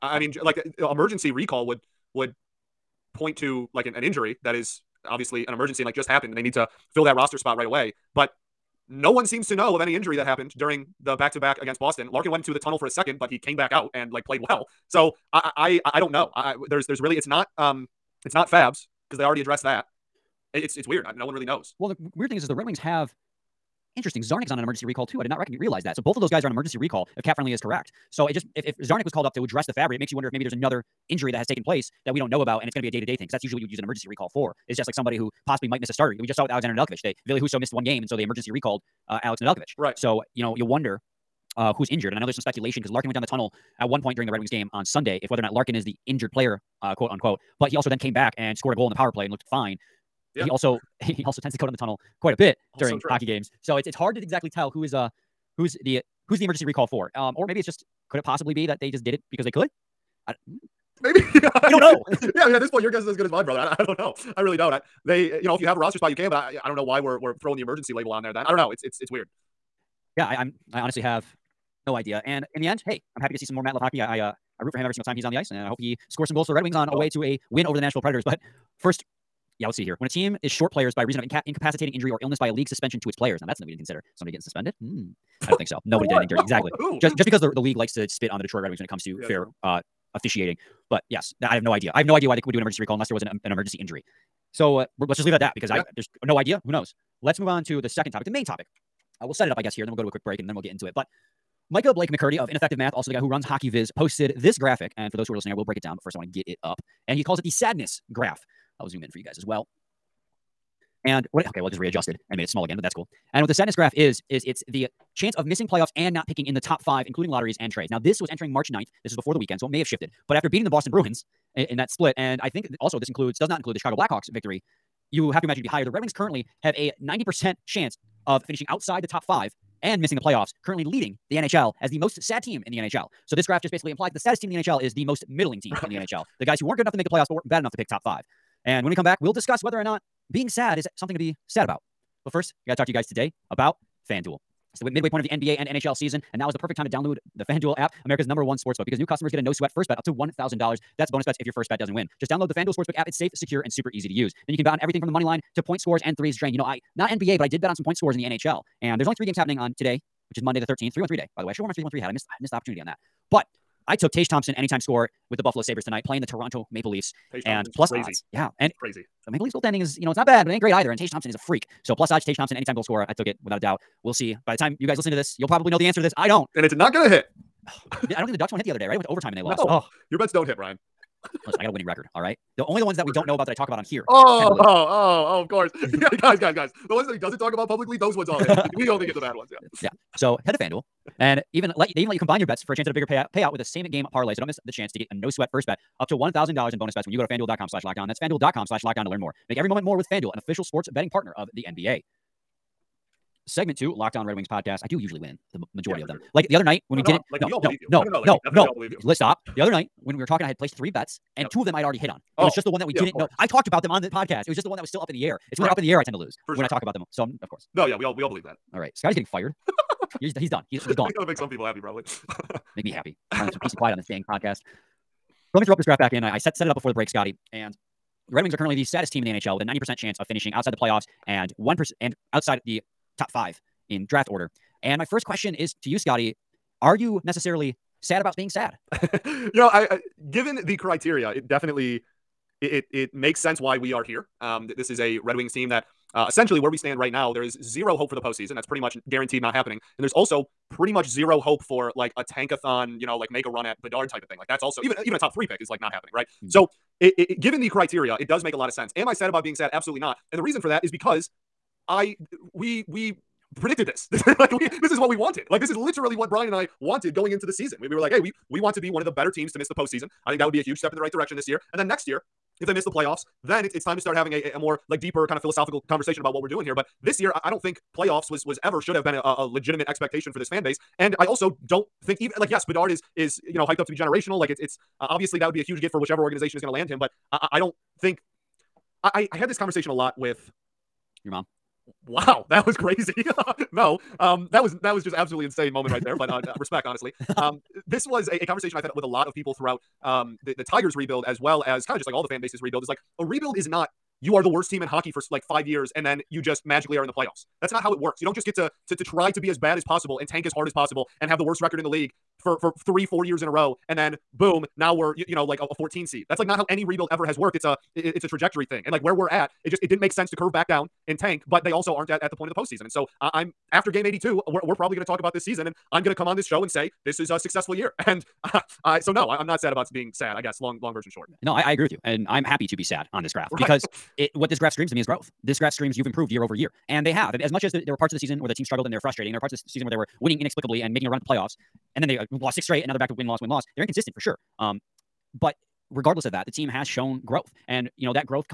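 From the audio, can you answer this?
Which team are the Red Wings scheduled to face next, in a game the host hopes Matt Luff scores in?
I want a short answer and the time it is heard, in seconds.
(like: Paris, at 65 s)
Nashville Predators, at 77 s.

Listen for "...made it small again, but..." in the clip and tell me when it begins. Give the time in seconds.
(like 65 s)
112 s.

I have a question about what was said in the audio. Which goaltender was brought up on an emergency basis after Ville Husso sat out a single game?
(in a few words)
Alex Nedeljkovic.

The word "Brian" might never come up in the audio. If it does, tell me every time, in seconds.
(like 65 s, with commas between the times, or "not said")
180 s, 266 s.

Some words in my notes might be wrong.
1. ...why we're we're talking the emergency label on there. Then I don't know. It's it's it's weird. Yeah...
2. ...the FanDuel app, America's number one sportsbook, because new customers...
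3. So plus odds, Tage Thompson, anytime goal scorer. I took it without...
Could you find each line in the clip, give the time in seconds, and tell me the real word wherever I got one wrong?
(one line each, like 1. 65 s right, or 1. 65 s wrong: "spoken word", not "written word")
1. 66 s wrong: "throwing", not "talking"
2. 147 s right
3. 171 s right.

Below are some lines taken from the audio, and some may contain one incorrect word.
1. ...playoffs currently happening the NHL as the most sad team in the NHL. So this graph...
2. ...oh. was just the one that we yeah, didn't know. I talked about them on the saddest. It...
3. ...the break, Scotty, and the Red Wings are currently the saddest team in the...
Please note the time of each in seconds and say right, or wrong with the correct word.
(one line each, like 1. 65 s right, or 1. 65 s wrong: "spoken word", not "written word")
1. 130 s wrong: "leading", not "happening"
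2. 212 s wrong: "podcast", not "saddest"
3. 226 s right.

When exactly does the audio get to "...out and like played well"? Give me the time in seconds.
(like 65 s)
13 s.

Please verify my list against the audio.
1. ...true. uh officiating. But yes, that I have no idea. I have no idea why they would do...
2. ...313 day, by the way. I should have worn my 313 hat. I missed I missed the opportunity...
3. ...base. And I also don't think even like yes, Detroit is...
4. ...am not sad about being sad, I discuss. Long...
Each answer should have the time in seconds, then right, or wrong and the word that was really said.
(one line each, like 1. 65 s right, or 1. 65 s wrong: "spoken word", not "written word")
1. 89 s right
2. 160 s right
3. 280 s wrong: "Bedard", not "Detroit"
4. 329 s wrong: "guess", not "discuss".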